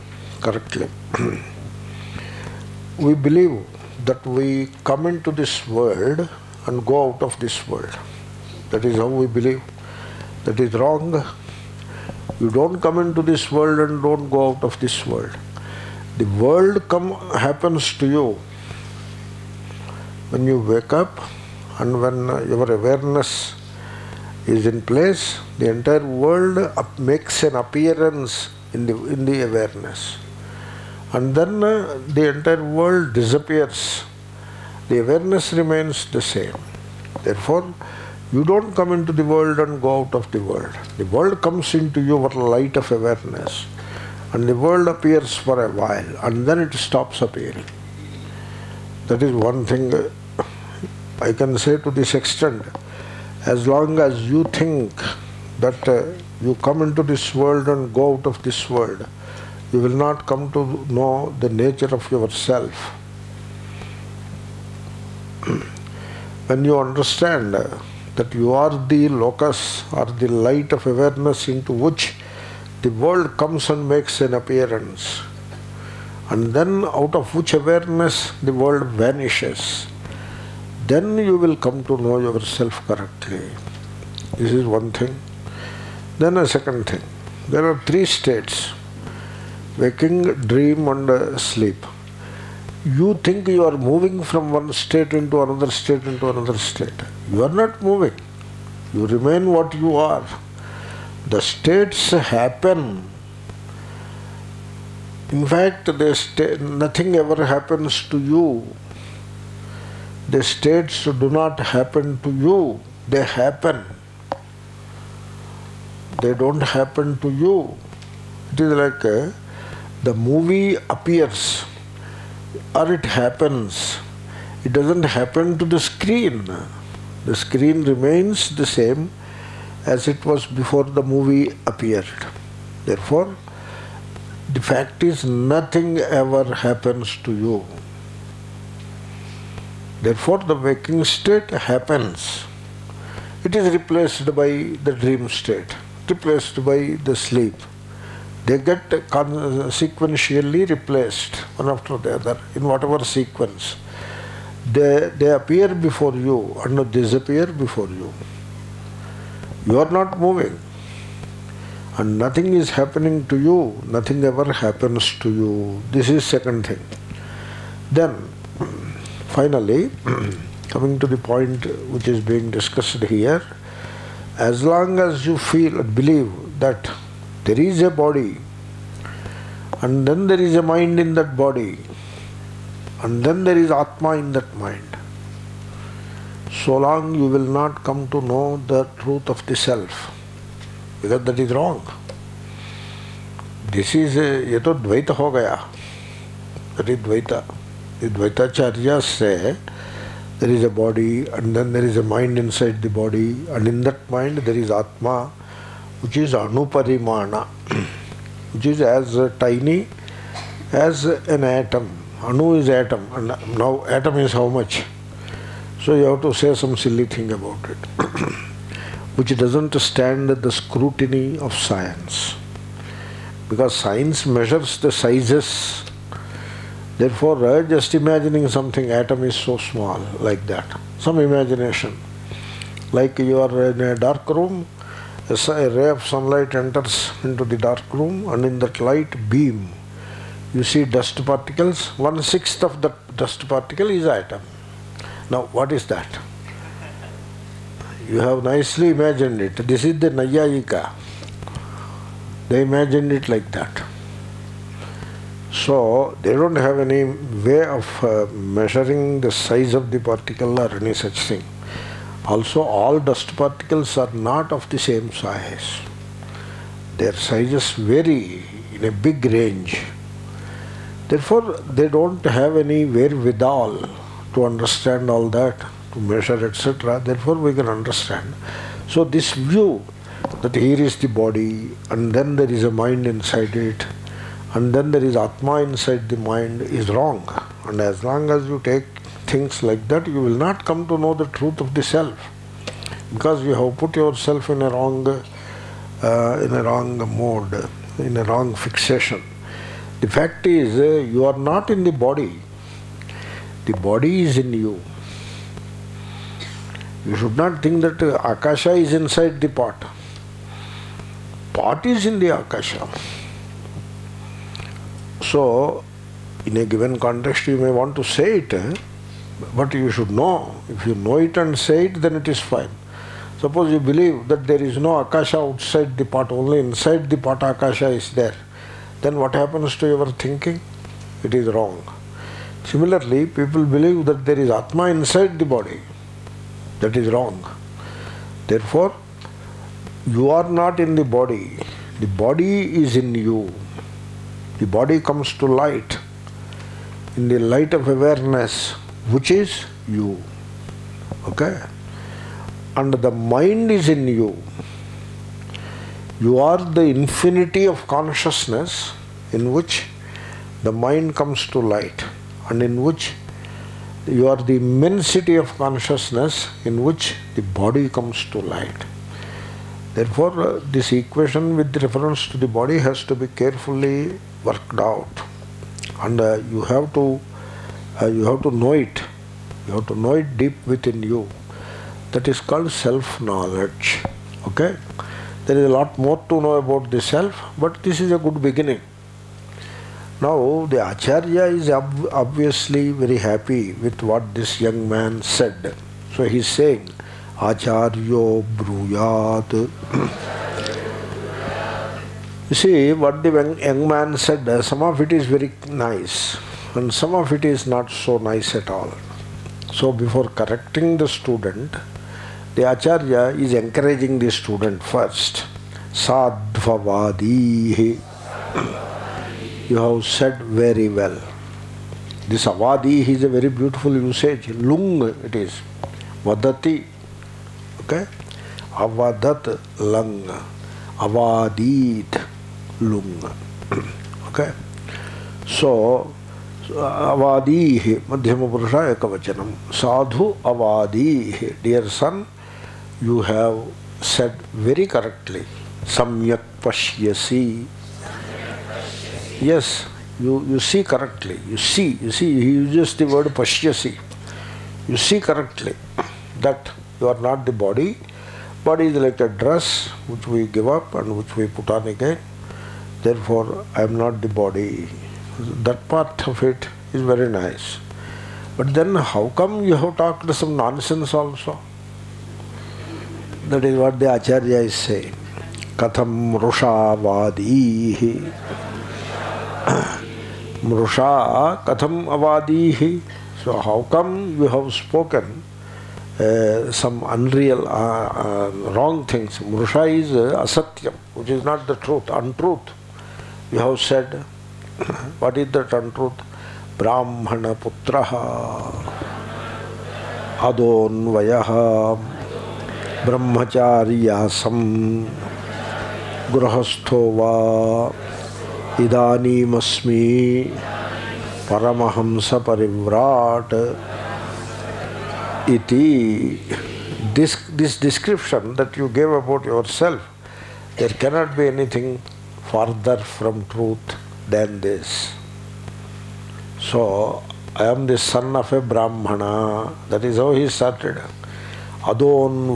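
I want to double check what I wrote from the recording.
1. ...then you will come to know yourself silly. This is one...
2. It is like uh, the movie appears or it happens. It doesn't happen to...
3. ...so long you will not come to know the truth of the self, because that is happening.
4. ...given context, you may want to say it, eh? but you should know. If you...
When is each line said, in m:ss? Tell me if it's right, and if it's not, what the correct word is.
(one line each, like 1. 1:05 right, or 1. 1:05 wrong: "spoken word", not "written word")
1. 1:20 wrong: "correctly", not "silly"
2. 1:58 right
3. 3:06 wrong: "wrong", not "happening"
4. 5:16 right.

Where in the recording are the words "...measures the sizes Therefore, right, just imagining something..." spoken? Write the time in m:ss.
3:44.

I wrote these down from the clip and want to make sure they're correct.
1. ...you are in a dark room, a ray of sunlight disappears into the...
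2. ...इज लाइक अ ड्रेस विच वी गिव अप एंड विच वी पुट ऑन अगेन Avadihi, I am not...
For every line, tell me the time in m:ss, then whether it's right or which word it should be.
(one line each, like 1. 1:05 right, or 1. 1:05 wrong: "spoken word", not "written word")
1. 3:53 wrong: "enters", not "disappears"
2. 7:38 wrong: "Therefore", not "Avadihi".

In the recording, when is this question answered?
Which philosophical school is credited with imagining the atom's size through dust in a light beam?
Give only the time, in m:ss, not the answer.
4:10.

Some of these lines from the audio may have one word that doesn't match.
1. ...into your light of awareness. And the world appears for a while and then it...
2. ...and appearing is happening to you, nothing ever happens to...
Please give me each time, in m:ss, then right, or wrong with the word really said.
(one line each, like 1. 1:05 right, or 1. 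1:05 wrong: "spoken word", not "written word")
1. 0:41 right
2. 2:41 wrong: "nothing", not "appearing".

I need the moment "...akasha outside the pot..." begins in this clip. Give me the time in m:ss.
5:24.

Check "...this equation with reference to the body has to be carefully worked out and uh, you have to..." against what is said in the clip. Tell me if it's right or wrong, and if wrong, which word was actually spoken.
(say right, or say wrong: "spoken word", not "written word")
right.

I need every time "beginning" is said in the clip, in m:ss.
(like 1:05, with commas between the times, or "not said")
6:28.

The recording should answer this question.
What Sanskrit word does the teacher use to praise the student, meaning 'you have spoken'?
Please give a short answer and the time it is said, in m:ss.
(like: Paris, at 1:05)
Avadi, at 7:02.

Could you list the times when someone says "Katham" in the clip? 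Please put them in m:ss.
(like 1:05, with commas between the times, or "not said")
7:55, 8:01.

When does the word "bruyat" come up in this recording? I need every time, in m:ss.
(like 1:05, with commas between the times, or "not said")
6:38.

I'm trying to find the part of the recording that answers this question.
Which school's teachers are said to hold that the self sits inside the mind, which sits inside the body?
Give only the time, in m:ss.
3:18.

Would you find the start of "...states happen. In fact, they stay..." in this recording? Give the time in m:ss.
1:41.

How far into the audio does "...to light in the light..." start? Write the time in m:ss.
5:45.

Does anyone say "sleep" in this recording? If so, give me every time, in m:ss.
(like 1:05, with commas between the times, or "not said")
1:31, 2:27.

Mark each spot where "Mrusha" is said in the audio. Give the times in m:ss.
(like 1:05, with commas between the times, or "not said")
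8:00, 8:09.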